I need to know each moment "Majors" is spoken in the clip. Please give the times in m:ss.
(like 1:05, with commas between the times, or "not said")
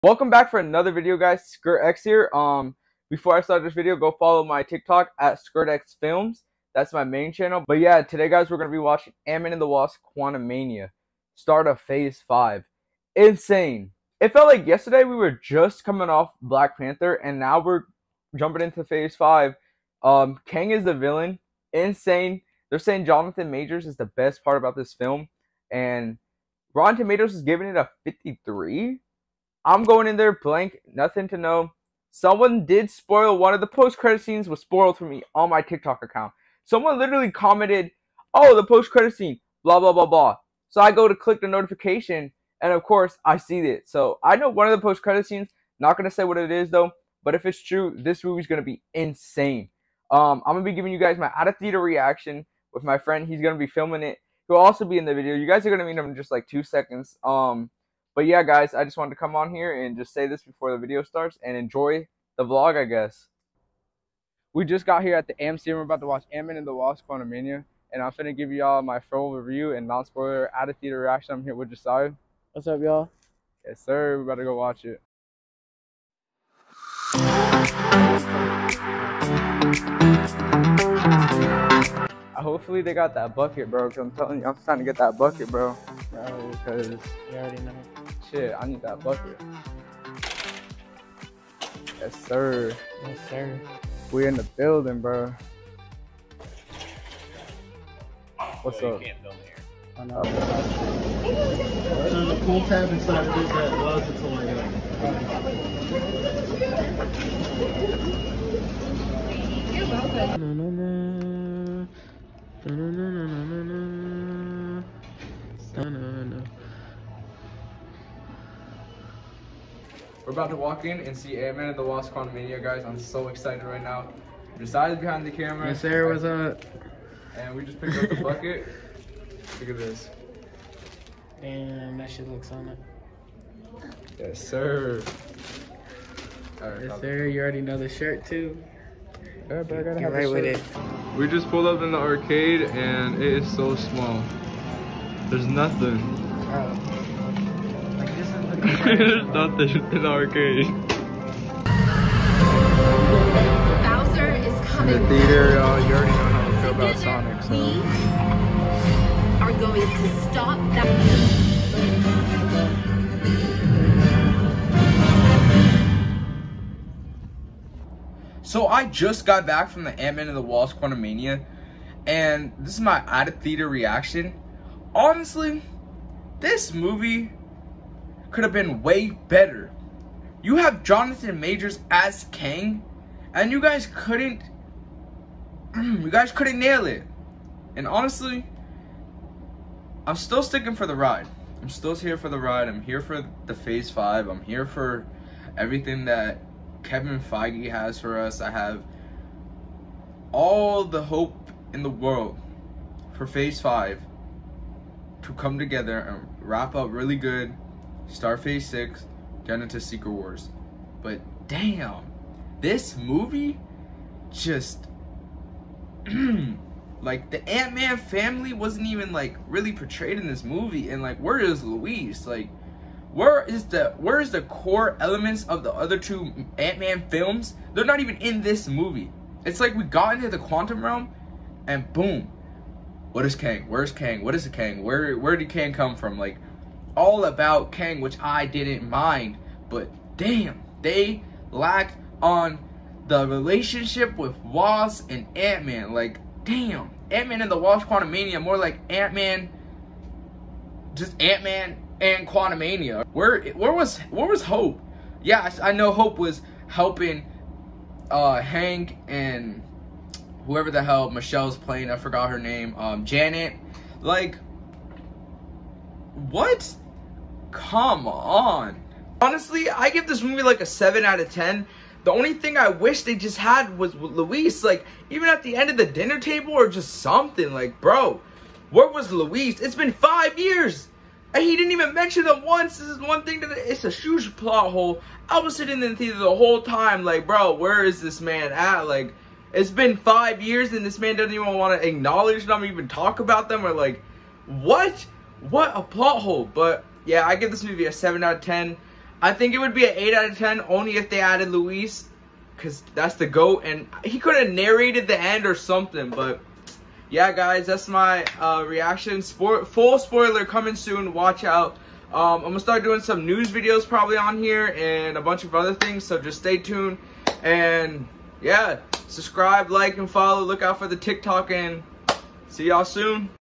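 0:23, 3:01.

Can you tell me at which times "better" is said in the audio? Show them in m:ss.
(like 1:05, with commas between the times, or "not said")
1:14, 2:59.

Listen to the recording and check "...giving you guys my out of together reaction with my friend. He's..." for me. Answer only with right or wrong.
wrong.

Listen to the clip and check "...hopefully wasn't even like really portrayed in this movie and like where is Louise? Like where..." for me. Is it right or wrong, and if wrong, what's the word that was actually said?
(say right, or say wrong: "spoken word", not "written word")
wrong: "family", not "hopefully".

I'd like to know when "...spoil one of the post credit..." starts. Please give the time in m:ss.
0:32.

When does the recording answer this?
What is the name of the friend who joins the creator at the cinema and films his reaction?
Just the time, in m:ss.
1:11.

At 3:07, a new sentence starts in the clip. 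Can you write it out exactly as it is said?
And honestly, I'm still sticking for the ride.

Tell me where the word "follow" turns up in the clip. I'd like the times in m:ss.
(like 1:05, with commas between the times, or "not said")
0:04, 5:20.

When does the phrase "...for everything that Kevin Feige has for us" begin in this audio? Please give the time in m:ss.
3:14.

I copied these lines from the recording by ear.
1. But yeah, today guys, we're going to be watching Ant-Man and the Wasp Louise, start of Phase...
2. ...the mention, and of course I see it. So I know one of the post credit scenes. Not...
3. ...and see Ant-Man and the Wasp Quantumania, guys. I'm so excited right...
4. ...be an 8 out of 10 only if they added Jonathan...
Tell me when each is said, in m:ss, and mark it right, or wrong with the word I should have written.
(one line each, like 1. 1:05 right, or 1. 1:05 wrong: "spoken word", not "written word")
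1. 0:07 wrong: "Quantumania", not "Louise"
2. 0:41 wrong: "notification", not "mention"
3. 2:01 right
4. 4:59 wrong: "Luis", not "Jonathan".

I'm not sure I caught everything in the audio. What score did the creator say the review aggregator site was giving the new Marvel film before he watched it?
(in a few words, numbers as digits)
53.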